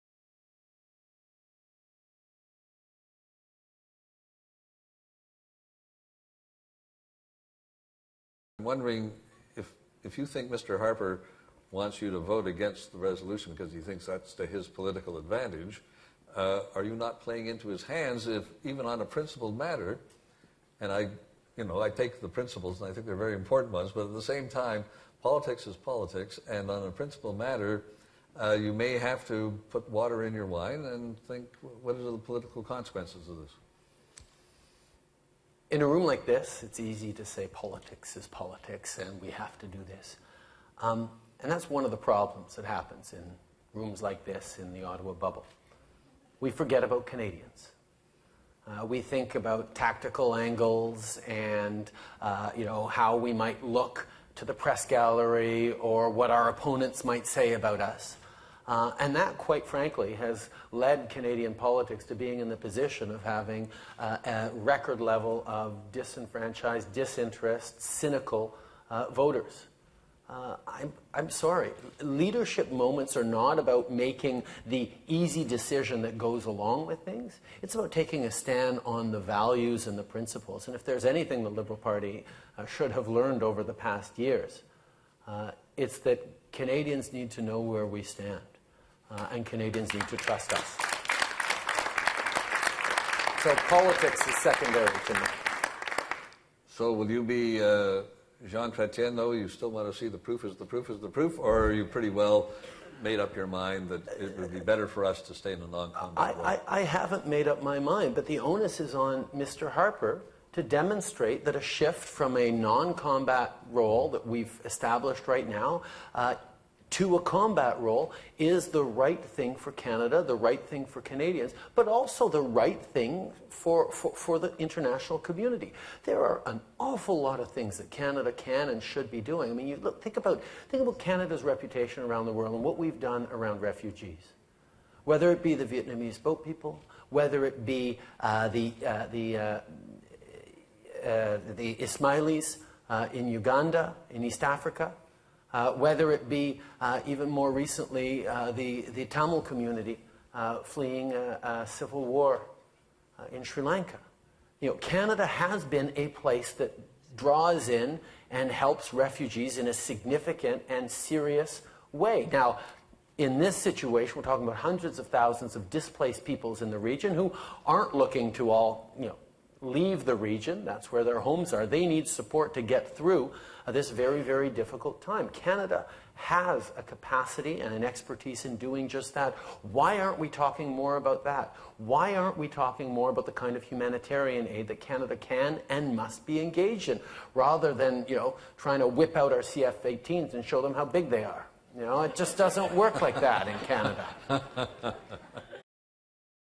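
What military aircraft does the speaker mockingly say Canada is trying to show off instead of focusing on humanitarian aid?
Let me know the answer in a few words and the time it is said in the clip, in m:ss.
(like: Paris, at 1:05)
CF-18s, at 3:09.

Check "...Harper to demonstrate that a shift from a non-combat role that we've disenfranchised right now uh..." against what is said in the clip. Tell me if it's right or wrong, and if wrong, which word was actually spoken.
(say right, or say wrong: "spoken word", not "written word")
wrong: "established", not "disenfranchised".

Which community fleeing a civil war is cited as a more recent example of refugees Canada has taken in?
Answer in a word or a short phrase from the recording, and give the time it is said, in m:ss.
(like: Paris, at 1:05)
Tamil, at 2:29.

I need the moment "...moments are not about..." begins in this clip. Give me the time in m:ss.
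1:12.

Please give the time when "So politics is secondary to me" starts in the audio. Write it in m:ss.
1:33.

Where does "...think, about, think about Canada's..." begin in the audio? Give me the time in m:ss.
2:10.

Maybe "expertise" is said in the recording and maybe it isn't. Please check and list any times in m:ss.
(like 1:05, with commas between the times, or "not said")
2:57.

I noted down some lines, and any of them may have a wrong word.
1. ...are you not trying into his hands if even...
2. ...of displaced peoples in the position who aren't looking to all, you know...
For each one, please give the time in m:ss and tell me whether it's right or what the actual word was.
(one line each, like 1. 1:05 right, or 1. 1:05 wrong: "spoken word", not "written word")
1. 0:16 wrong: "playing", not "trying"
2. 2:45 wrong: "region", not "position".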